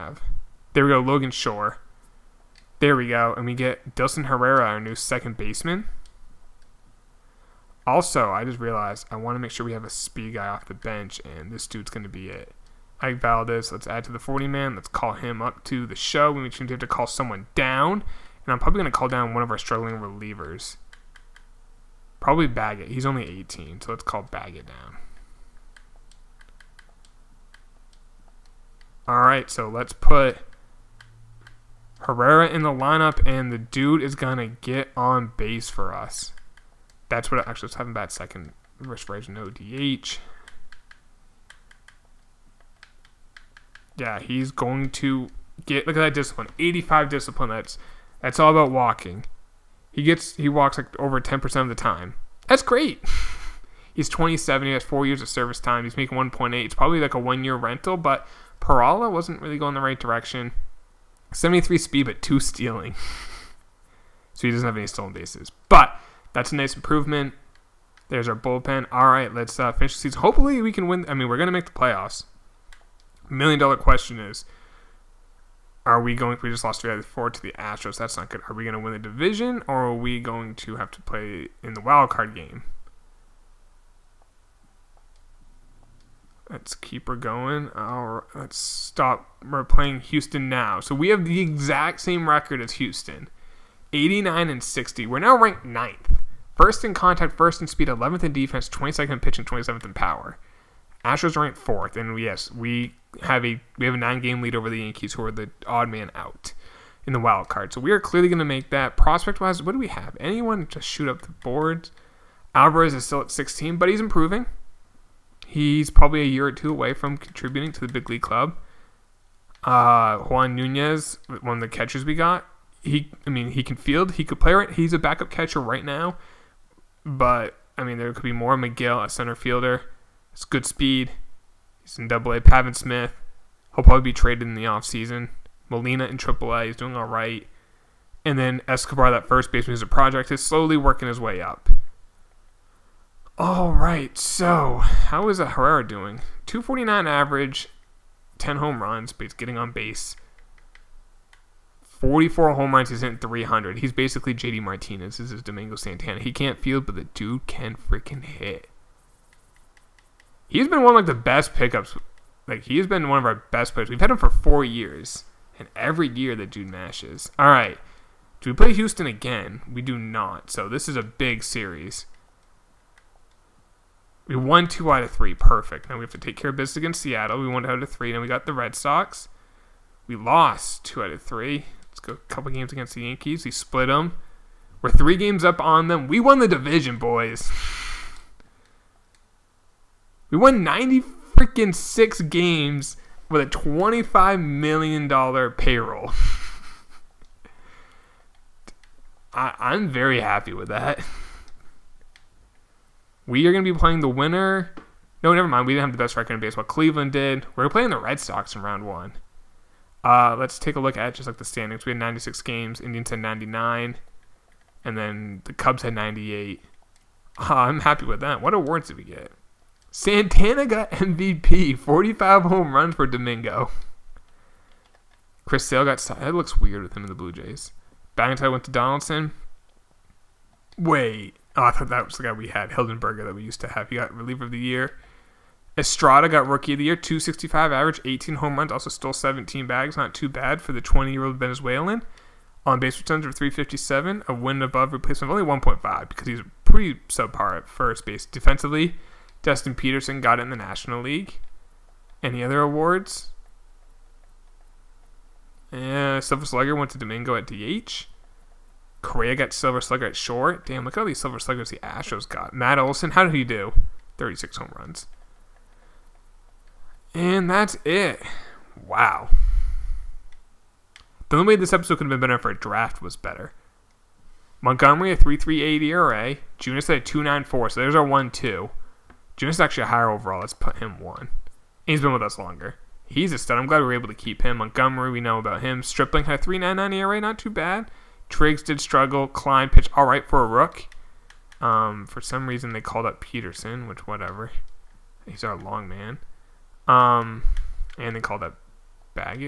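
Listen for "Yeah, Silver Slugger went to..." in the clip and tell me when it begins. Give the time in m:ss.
4:15.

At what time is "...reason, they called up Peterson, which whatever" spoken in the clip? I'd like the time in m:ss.
4:52.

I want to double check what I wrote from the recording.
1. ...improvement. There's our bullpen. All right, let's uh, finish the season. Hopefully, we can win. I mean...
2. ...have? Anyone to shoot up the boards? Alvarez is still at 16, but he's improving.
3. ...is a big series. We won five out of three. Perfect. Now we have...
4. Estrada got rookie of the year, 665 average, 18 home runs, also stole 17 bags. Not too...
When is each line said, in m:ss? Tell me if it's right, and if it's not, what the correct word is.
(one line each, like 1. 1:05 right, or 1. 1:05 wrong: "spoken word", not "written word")
1. 1:06 right
2. 1:49 right
3. 2:50 wrong: "two", not "five"
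4. 3:55 wrong: "265", not "665".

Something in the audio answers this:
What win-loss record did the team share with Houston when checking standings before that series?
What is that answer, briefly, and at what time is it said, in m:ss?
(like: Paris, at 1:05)
89 and 60, at 1:33.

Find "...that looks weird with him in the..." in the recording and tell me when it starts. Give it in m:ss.
3:45.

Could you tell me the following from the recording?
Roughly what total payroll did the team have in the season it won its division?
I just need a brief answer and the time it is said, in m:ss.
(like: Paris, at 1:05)
$25 million, at 3:13.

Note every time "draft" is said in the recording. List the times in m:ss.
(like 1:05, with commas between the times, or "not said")
4:32.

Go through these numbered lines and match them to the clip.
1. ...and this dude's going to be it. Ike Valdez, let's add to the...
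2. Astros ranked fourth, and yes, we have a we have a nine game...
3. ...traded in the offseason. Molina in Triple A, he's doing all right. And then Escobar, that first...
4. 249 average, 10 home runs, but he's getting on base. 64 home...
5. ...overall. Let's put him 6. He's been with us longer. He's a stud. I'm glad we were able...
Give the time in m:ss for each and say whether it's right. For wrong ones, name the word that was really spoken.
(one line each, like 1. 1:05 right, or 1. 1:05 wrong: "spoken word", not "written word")
1. 0:11 right
2. 1:41 right
3. 2:14 right
4. 2:26 wrong: "44", not "64"
5. 4:40 wrong: "1", not "6".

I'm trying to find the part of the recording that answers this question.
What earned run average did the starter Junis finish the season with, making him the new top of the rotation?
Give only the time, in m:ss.
4:37.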